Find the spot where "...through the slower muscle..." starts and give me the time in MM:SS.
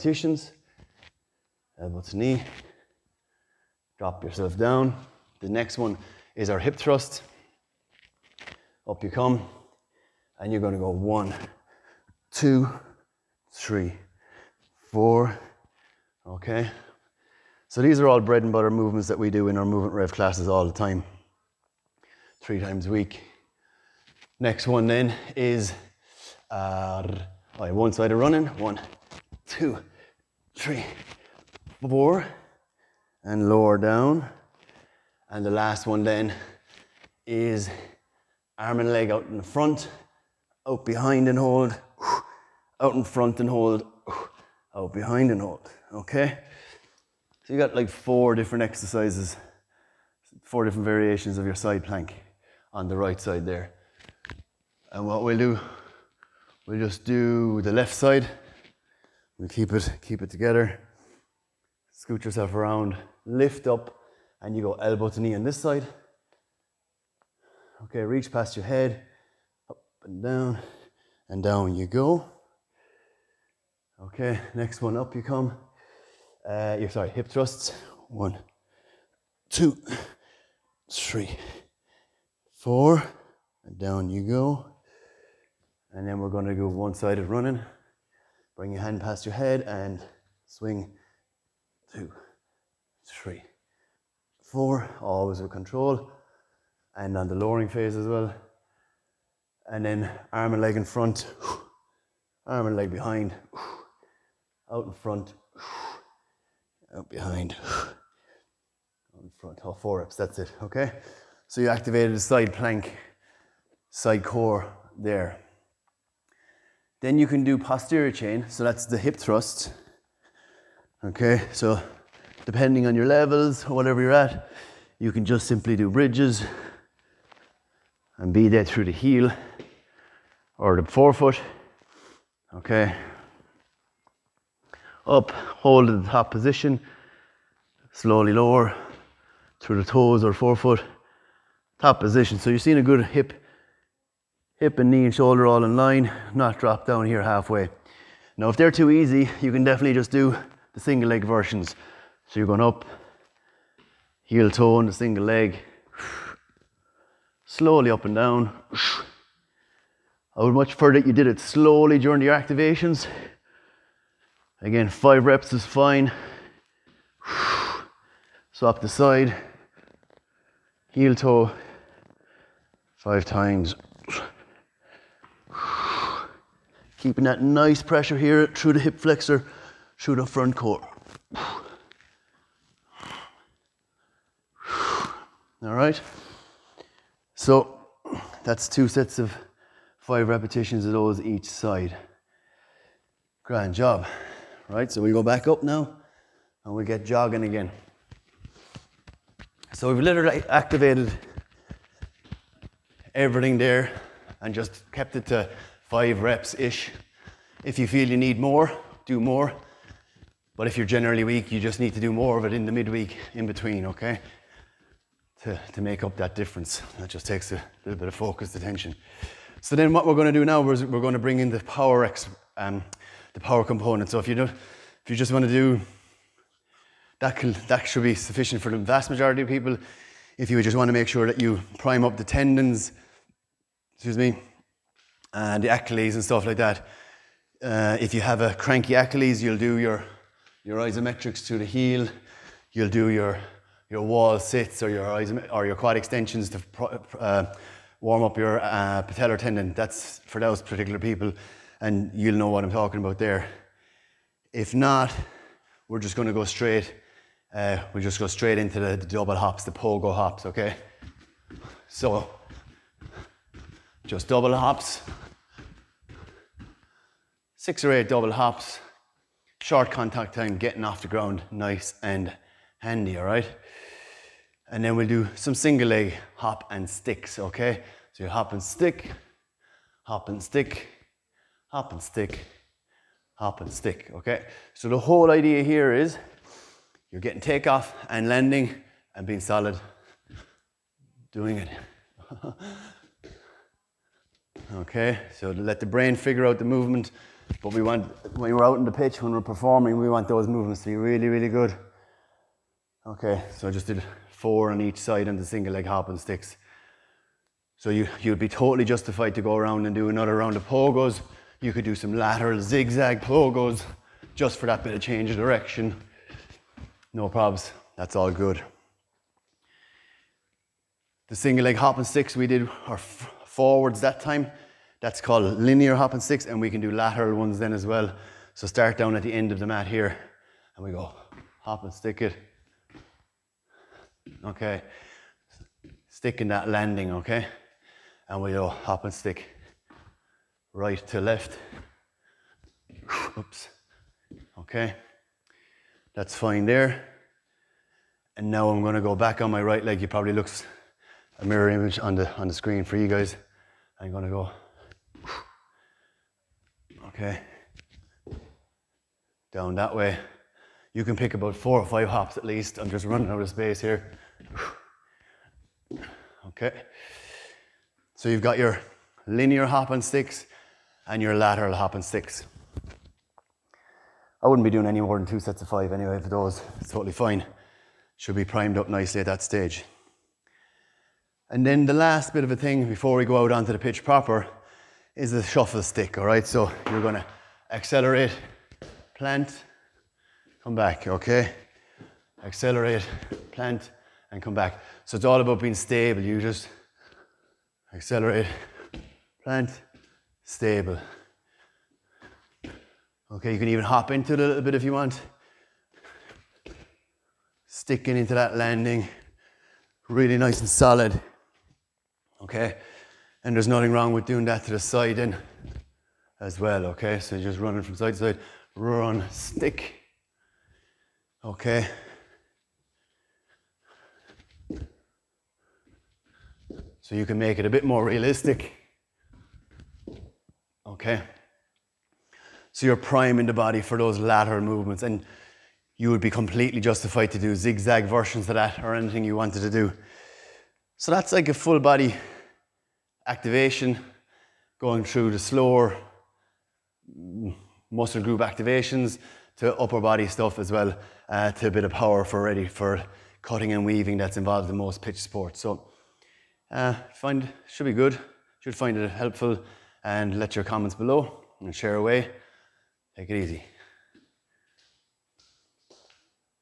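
07:25.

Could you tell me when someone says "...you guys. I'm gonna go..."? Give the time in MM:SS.
05:52.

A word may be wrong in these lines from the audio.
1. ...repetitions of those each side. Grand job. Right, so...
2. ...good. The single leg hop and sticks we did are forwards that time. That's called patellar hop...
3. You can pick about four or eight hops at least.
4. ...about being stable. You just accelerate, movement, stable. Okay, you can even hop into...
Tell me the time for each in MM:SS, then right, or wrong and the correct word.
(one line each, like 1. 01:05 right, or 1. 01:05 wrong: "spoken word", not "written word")
1. 03:10 right
2. 05:18 wrong: "linear", not "patellar"
3. 06:00 wrong: "five", not "eight"
4. 06:35 wrong: "plant", not "movement".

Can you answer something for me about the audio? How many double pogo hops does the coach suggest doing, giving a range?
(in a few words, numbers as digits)
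6 or 8.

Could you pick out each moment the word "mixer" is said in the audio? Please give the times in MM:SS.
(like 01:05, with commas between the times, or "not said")
not said.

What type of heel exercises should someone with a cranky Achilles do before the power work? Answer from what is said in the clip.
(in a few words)
isometrics.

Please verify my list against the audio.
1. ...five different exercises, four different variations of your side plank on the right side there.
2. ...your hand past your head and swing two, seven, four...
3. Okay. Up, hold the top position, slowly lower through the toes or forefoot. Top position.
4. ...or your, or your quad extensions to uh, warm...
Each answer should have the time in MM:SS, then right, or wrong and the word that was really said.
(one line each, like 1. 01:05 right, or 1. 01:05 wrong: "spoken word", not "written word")
1. 00:47 wrong: "four", not "five"
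2. 01:28 wrong: "three", not "seven"
3. 02:12 right
4. 04:04 right.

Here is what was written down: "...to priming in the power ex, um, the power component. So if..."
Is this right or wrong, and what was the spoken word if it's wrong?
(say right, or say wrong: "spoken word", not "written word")
wrong: "bring", not "priming".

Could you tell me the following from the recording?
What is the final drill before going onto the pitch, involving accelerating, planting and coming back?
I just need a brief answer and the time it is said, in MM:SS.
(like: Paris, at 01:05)
shuffle stick, at 06:25.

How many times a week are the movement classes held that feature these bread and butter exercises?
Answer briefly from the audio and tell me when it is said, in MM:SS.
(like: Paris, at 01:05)
3, at 00:22.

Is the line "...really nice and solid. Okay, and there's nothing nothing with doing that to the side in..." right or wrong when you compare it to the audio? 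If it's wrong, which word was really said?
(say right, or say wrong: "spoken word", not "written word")
wrong: "wrong", not "nothing".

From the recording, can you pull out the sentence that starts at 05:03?
Okay, so I just did four on each side and the single leg hop and sticks.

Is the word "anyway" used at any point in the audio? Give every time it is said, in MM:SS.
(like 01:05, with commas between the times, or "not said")
06:15.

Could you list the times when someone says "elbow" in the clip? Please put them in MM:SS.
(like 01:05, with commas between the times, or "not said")
00:01, 01:04.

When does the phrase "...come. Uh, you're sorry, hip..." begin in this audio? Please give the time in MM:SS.
01:15.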